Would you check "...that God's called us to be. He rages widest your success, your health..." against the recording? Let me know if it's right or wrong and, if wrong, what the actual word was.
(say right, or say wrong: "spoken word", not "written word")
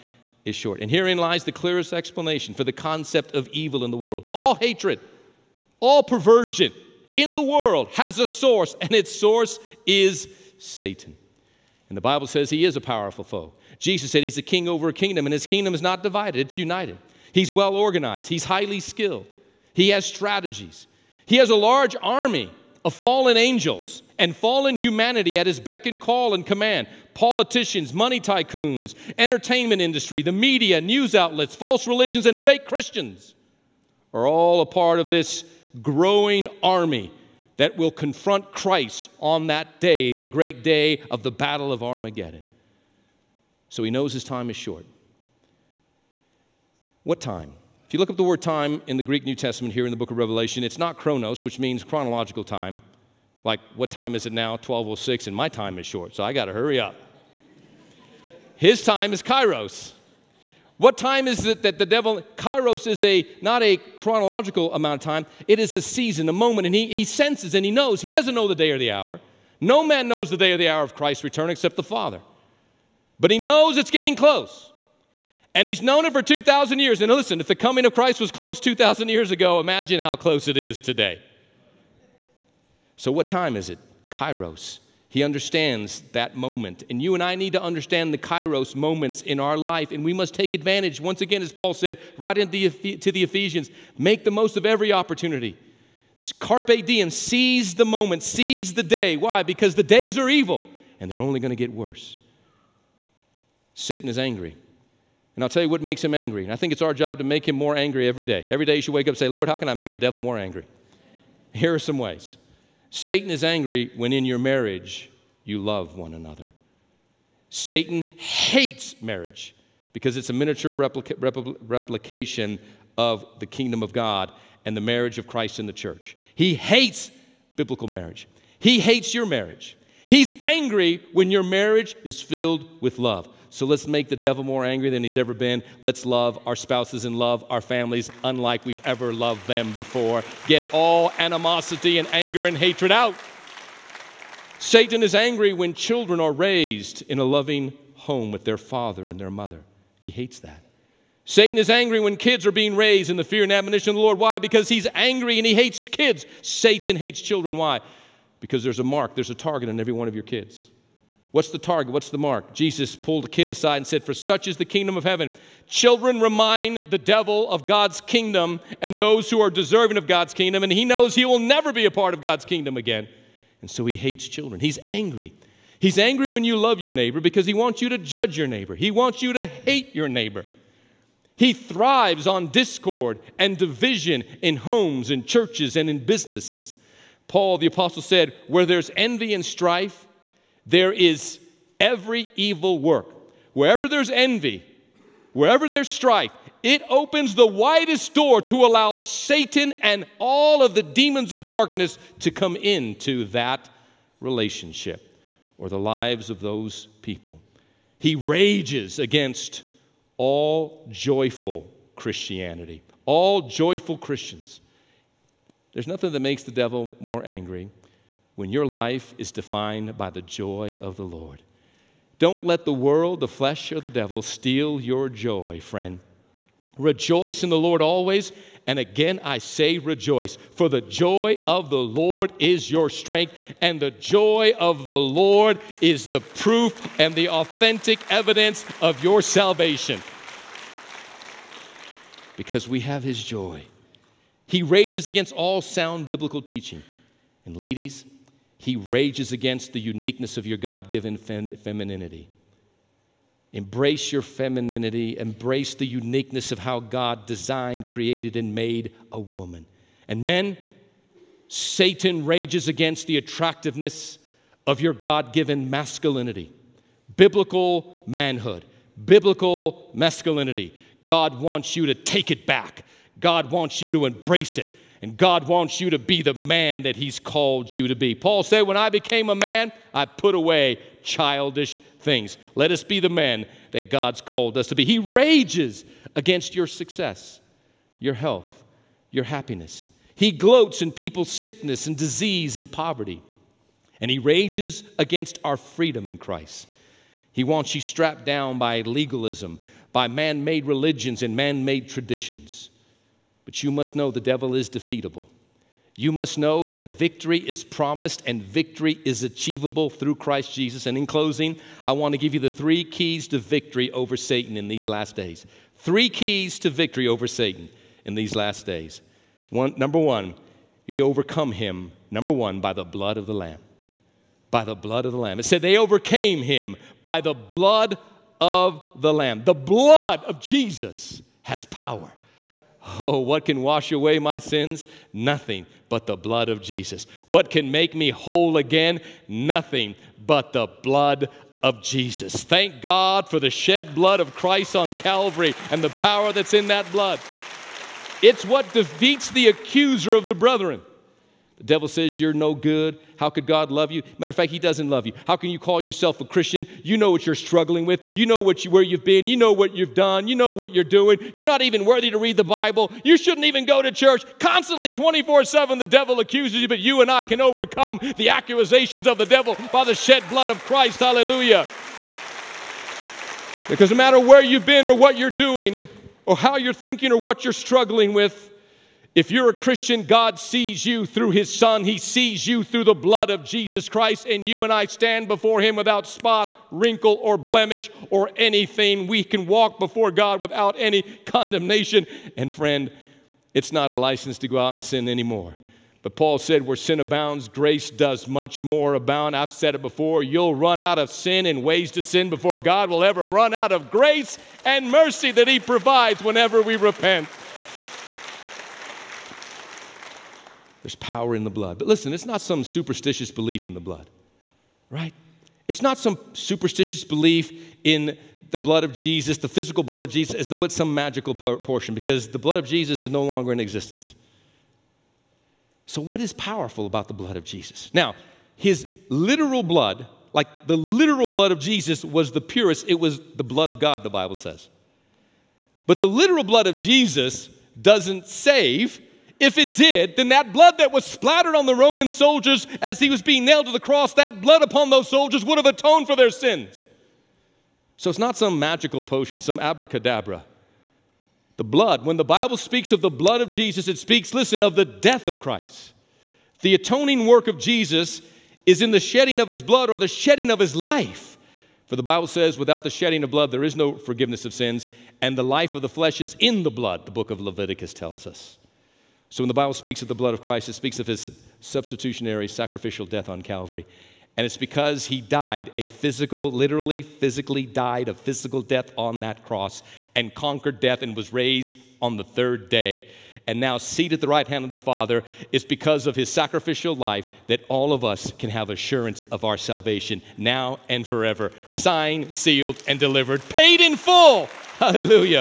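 wrong: "against", not "widest".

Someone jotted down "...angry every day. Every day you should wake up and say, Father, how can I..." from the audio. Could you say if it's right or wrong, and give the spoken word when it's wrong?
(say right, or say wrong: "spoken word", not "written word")
wrong: "Lord", not "Father".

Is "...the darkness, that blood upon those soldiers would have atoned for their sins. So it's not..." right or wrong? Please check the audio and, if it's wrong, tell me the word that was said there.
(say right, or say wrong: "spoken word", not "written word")
wrong: "cross", not "darkness".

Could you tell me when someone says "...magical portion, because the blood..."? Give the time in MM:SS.
07:00.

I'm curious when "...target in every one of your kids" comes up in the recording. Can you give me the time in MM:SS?
02:39.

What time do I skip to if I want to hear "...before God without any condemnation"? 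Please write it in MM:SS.
06:29.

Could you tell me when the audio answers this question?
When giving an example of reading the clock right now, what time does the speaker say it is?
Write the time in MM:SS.
00:54.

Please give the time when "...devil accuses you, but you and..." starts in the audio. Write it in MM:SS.
06:05.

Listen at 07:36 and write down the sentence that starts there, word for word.
The atoning work of Jesus is in the shedding of his blood or the shedding of his life.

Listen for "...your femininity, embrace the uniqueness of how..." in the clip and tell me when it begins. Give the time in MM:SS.
04:14.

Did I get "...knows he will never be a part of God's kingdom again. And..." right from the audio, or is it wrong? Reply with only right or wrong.
right.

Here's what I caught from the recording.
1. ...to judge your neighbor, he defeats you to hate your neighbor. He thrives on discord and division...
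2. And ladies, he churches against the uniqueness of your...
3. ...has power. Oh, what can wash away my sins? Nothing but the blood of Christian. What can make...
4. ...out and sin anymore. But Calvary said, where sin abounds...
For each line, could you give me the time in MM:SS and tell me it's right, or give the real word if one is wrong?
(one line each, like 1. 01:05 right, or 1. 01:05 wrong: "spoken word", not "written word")
1. 02:57 wrong: "wants", not "defeats"
2. 04:07 wrong: "rages", not "churches"
3. 05:31 wrong: "Jesus", not "Christian"
4. 06:34 wrong: "Paul", not "Calvary".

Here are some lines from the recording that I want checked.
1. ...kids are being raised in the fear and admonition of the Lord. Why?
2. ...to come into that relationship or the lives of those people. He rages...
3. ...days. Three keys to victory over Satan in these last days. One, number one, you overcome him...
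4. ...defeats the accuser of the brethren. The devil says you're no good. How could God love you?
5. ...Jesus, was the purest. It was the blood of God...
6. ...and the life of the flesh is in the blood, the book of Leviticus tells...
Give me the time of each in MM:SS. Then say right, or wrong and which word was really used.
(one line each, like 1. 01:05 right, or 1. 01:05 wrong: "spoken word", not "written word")
1. 02:32 right
2. 03:22 right
3. 05:15 right
4. 05:48 right
5. 07:11 right
6. 07:45 right.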